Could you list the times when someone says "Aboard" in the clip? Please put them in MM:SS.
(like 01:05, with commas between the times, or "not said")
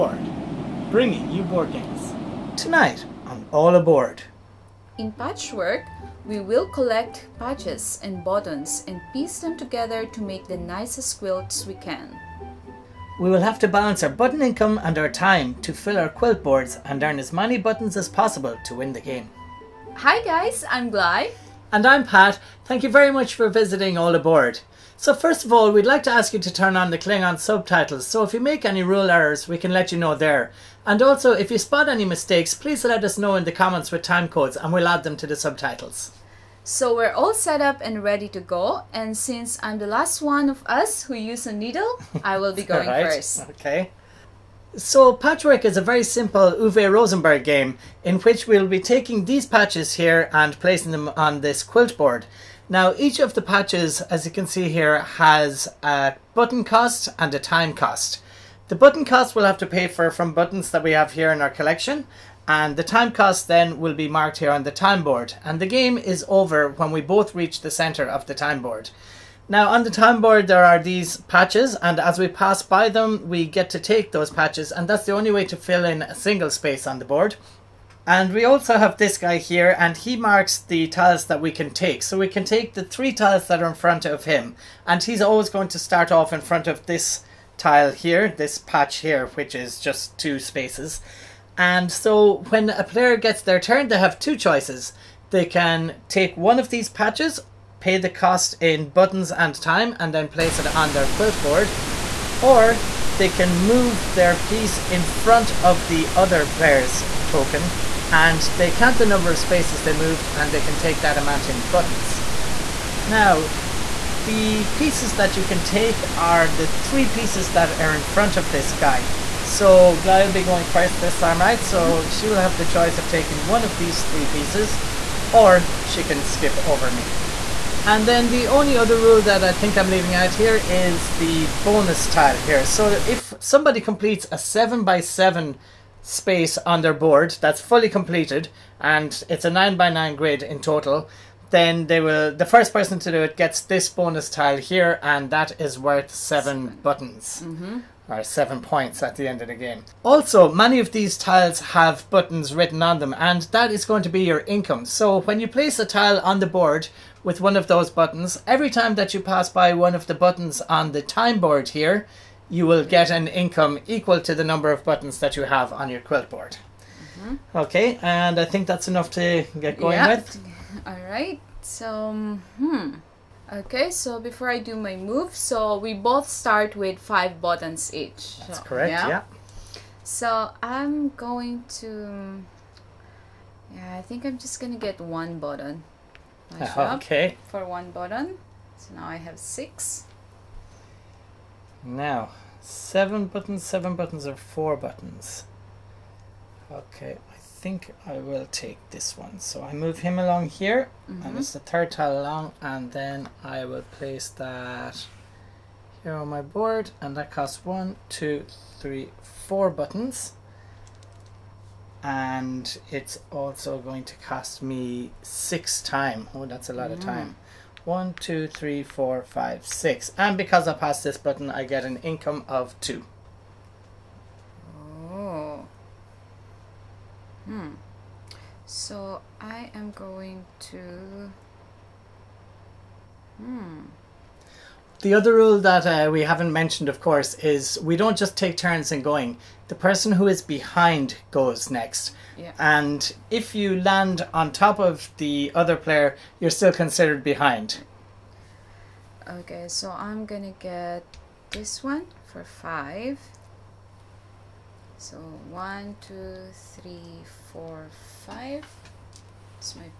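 00:03, 00:24.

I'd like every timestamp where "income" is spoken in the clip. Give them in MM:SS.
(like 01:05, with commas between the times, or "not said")
00:14, 02:34, 02:43, 03:42.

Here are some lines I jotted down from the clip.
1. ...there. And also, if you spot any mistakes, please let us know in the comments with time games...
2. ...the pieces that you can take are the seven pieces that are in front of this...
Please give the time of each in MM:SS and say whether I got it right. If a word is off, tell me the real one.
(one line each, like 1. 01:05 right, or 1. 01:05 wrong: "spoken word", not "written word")
1. 00:30 wrong: "codes", not "games"
2. 01:54 wrong: "three", not "seven".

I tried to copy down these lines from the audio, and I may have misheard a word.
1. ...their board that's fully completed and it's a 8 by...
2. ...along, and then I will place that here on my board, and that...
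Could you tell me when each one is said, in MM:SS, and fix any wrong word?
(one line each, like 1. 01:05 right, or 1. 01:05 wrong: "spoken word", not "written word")
1. 02:16 wrong: "9", not "8"
2. 03:22 right.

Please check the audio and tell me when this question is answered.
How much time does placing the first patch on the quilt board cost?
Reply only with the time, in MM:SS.
03:35.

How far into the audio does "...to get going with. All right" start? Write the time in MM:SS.
02:49.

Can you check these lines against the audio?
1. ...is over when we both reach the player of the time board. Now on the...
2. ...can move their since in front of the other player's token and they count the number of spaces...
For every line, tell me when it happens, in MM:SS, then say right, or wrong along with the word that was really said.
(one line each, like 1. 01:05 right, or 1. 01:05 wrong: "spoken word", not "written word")
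1. 01:05 wrong: "center", not "player"
2. 01:43 wrong: "piece", not "since".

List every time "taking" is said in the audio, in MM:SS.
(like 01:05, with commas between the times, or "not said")
00:48, 02:03.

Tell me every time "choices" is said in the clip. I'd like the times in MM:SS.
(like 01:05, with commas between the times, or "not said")
01:34, 02:02.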